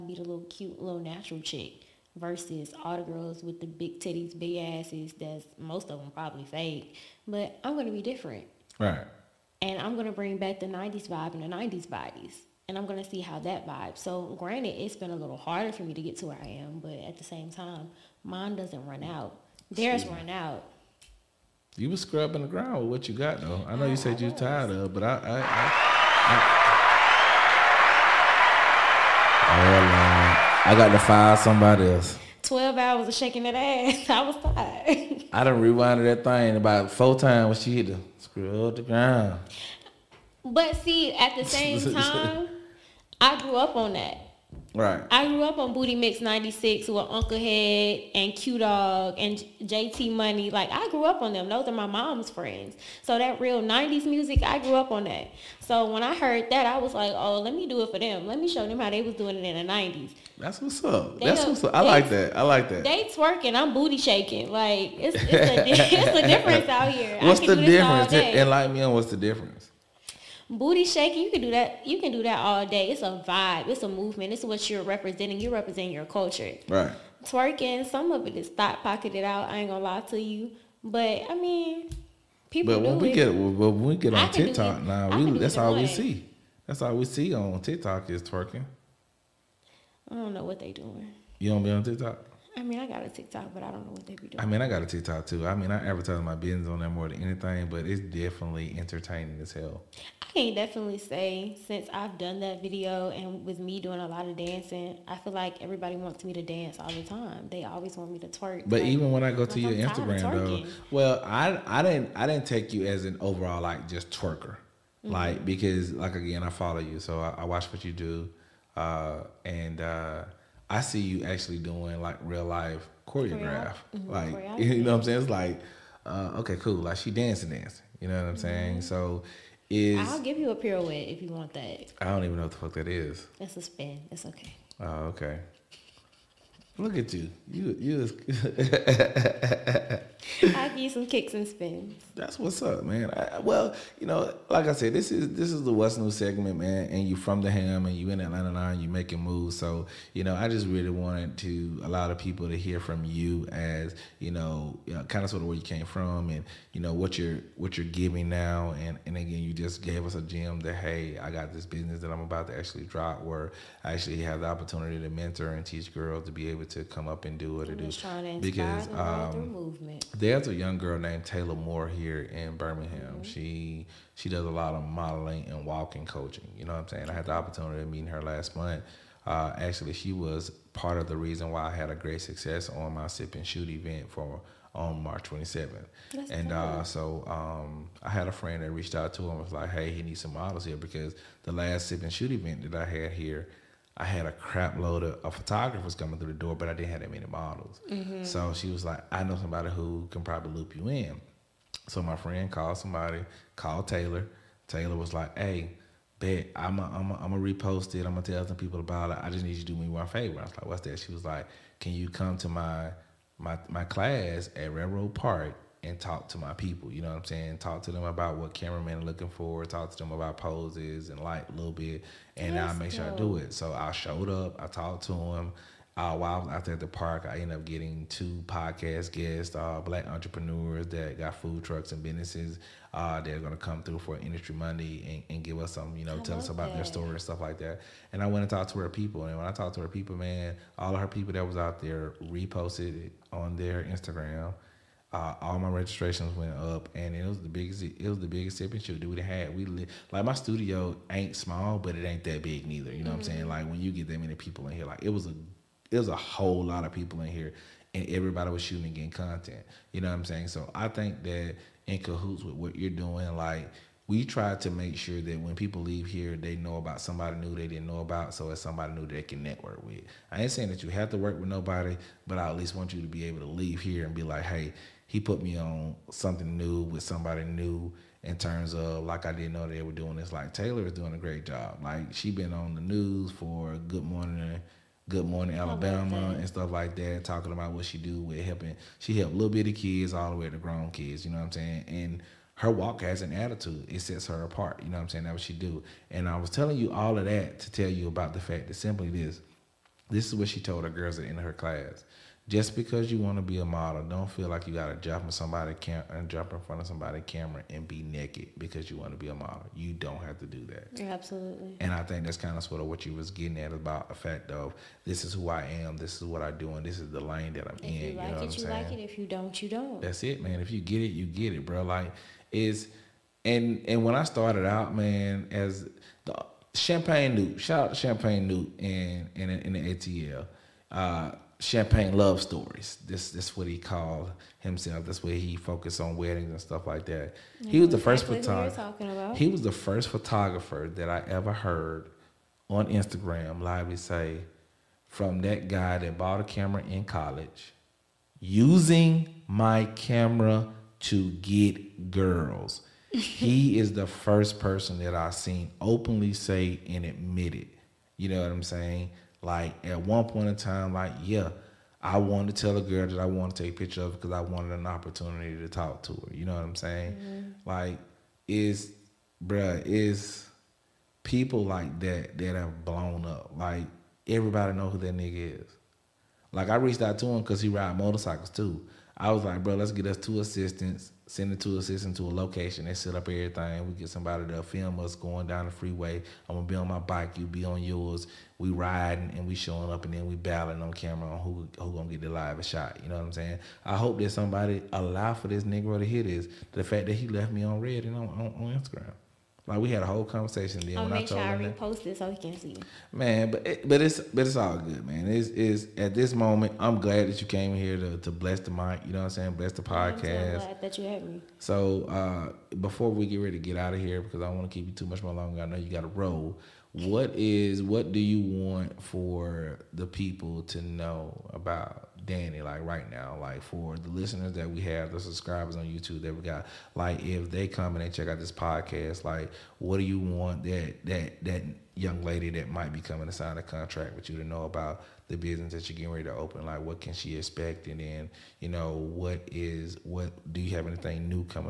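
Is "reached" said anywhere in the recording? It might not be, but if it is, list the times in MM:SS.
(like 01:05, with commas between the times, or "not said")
03:08, 06:16.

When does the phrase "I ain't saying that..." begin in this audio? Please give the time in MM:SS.
04:30.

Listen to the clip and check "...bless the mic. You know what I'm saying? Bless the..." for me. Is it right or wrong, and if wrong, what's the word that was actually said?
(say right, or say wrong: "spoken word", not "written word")
right.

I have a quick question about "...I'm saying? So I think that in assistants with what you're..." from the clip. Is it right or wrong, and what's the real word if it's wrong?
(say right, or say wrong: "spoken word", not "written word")
wrong: "cahoots", not "assistants".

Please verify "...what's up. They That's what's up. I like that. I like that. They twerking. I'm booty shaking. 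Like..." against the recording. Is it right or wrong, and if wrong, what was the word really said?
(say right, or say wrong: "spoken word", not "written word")
right.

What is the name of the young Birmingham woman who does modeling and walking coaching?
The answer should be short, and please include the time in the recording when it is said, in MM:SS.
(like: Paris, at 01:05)
Taylor Moore, at 02:51.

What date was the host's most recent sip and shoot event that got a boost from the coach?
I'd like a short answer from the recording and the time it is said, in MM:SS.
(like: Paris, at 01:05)
March 27th, at 03:05.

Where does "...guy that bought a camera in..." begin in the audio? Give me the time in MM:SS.
05:45.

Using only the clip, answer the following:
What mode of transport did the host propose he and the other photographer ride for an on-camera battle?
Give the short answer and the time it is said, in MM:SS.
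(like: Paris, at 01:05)
motorcycles, at 06:17.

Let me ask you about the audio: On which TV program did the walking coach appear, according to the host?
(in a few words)
Good Morning Alabama.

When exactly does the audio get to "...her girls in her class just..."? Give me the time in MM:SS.
05:00.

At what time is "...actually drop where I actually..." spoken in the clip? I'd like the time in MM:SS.
02:42.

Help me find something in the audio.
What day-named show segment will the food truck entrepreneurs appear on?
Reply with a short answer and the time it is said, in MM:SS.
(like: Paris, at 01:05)
Industry Monday, at 03:54.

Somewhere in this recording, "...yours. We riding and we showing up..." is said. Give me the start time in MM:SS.
06:27.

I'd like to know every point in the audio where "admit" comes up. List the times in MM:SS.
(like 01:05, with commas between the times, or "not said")
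05:57.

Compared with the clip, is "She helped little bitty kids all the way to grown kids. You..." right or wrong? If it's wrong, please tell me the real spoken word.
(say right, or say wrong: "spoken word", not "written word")
right.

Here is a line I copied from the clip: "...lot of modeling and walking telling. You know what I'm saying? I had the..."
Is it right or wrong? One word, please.
wrong.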